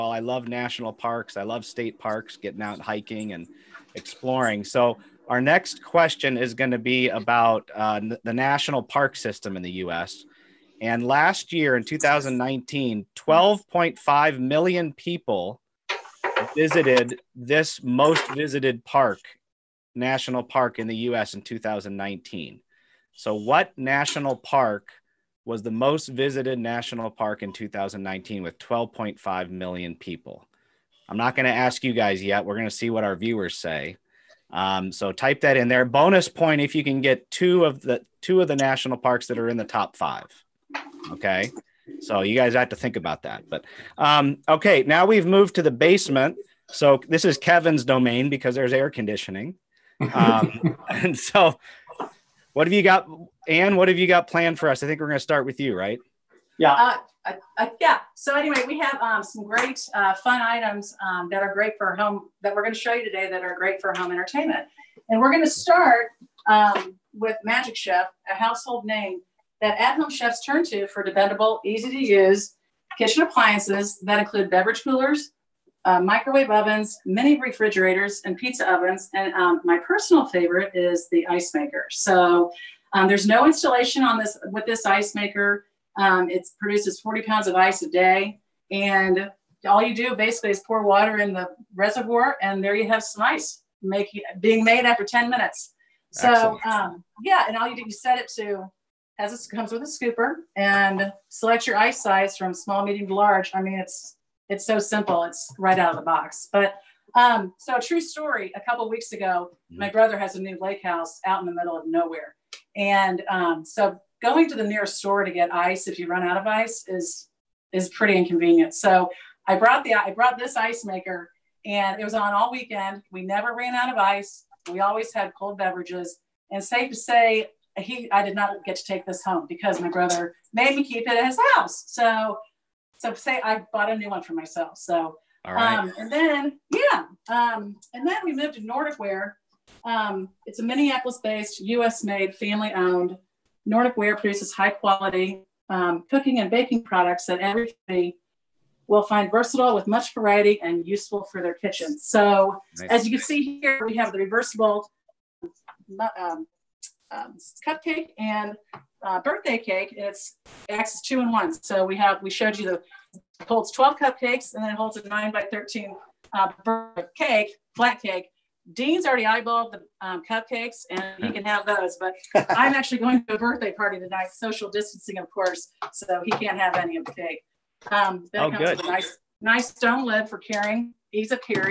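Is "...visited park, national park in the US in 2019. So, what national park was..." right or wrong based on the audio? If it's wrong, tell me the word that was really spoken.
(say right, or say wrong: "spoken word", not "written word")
right.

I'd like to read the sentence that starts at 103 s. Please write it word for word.
I mean, it's it's so simple.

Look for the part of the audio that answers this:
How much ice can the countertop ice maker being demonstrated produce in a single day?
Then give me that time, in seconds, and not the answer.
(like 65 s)
86 s.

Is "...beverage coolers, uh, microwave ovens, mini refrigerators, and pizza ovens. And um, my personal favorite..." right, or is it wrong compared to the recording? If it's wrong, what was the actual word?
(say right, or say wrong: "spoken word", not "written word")
right.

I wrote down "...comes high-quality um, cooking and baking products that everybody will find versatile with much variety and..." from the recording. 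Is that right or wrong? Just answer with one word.
wrong.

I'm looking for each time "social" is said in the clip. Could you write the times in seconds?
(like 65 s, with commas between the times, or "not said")
174 s.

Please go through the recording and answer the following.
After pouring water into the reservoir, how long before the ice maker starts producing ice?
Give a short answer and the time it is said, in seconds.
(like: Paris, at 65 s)
10 minutes, at 95 s.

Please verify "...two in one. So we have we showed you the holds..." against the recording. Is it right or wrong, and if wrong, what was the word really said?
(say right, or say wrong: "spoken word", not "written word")
right.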